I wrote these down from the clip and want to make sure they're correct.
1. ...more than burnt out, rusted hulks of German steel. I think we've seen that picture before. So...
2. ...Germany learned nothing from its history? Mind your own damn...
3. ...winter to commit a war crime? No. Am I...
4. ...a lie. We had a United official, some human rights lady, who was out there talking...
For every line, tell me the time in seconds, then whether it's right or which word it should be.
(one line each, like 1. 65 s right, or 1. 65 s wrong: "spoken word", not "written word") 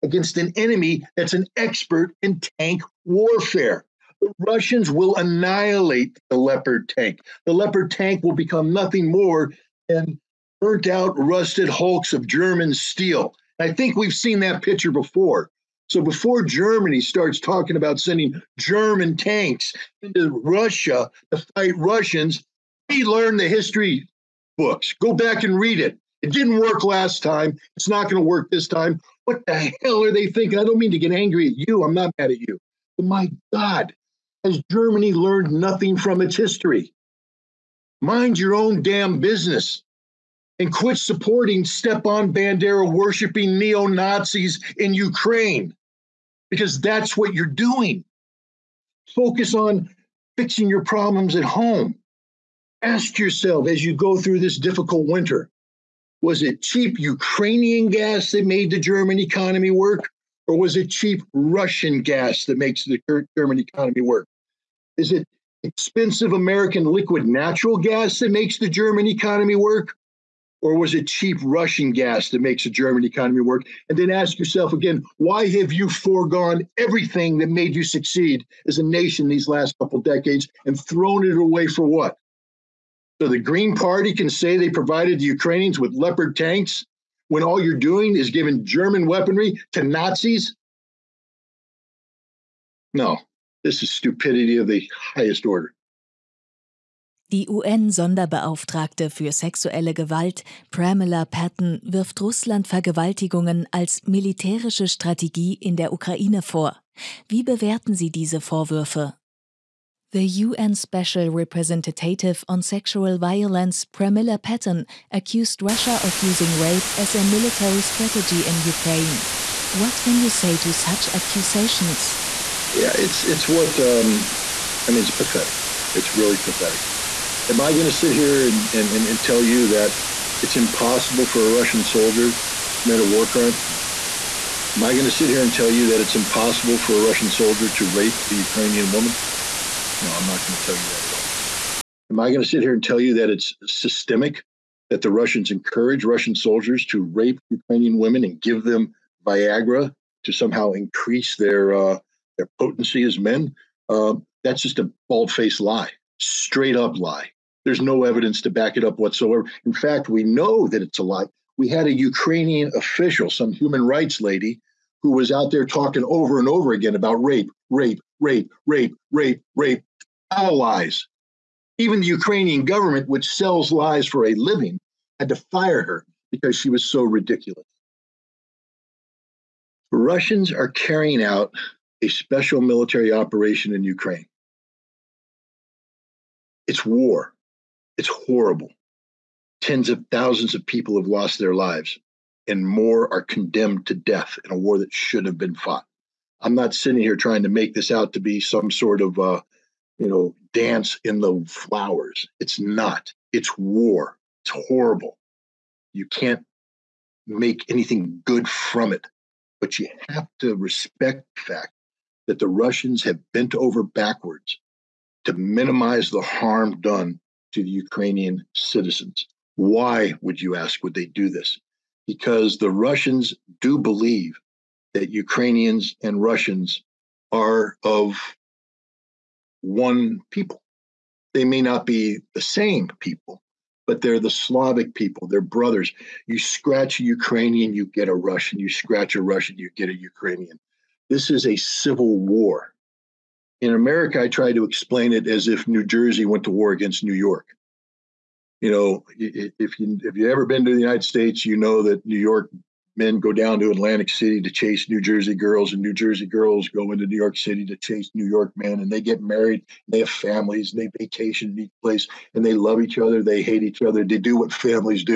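1. 9 s right
2. 34 s right
3. 131 s wrong: "soldier", not "winter"
4. 160 s wrong: "Ukrainian", not "United".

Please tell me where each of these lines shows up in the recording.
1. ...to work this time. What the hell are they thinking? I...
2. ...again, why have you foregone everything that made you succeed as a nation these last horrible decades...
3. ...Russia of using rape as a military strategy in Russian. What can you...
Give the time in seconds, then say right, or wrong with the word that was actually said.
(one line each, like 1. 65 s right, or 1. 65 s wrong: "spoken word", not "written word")
1. 28 s right
2. 74 s wrong: "couple", not "horrible"
3. 115 s wrong: "Ukraine", not "Russian".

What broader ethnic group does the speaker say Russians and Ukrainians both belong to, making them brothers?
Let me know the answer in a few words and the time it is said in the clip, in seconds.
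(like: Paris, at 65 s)
Slavic, at 234 s.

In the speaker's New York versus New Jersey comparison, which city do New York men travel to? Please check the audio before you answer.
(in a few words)
Atlantic City.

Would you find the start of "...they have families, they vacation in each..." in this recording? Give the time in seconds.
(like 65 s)
259 s.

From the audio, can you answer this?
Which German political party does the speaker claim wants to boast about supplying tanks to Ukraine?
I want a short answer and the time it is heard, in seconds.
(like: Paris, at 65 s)
Green Party, at 83 s.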